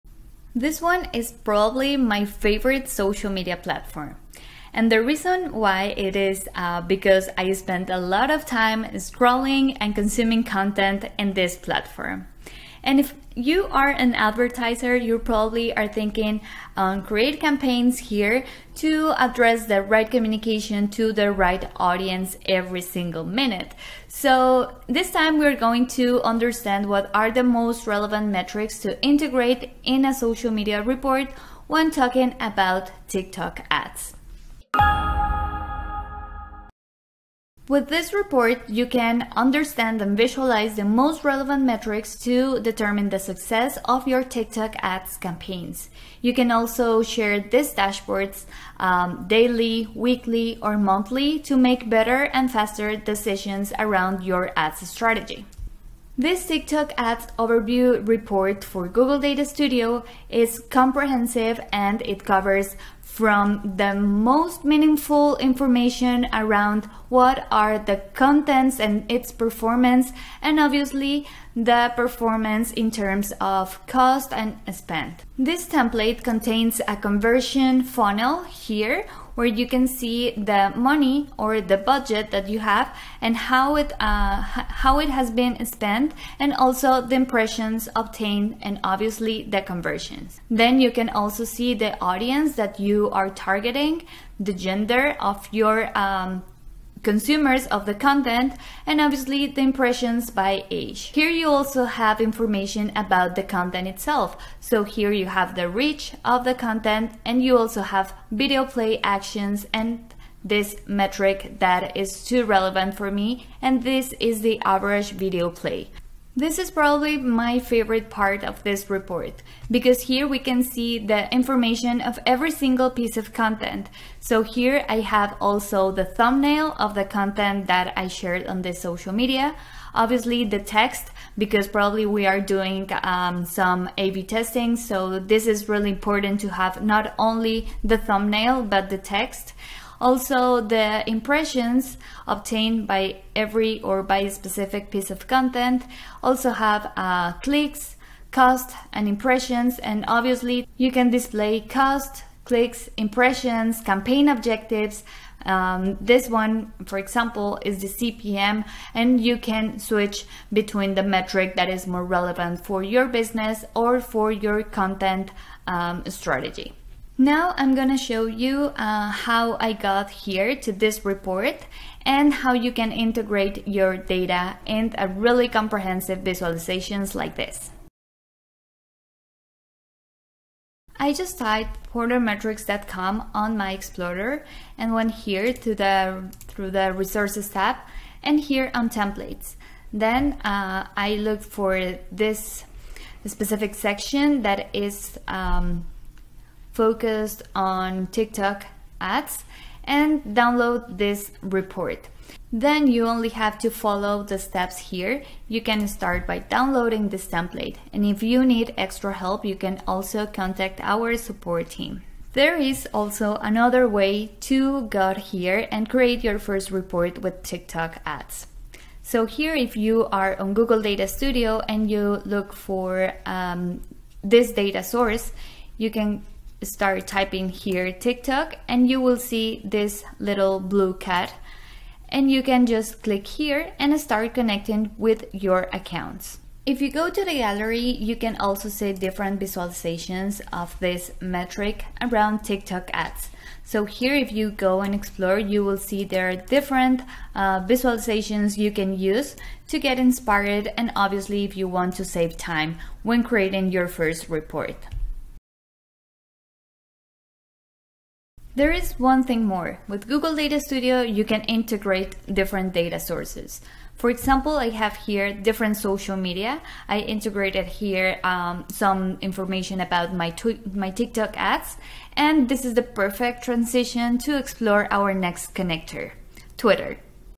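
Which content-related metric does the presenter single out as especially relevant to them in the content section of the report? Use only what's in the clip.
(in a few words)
average video play.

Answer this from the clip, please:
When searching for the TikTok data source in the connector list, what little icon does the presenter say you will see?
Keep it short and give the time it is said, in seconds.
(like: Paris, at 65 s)
little blue cat, at 230 s.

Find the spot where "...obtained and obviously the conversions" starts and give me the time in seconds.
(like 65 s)
87 s.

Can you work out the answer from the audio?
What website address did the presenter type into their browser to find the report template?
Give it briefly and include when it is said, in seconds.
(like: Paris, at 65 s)
portermetrics.com, at 181 s.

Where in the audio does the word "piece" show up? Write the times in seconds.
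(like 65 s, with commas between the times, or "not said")
122 s, 144 s.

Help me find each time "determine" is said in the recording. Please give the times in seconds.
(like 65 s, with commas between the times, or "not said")
42 s.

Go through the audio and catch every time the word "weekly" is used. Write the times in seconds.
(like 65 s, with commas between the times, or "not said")
49 s.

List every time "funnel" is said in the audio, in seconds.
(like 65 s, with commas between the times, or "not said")
77 s.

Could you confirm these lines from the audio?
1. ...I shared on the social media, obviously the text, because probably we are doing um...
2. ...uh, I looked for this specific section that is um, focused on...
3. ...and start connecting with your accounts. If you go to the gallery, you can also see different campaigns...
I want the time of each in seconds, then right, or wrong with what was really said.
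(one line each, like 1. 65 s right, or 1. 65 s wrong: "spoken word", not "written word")
1. 127 s right
2. 190 s right
3. 233 s wrong: "visualizations", not "campaigns".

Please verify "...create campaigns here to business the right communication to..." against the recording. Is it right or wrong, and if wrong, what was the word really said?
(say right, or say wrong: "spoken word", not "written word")
wrong: "address", not "business".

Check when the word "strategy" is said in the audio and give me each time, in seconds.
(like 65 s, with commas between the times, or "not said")
54 s, 166 s.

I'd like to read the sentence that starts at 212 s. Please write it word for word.
There is also another way to go here and create your first report with TikTok ads.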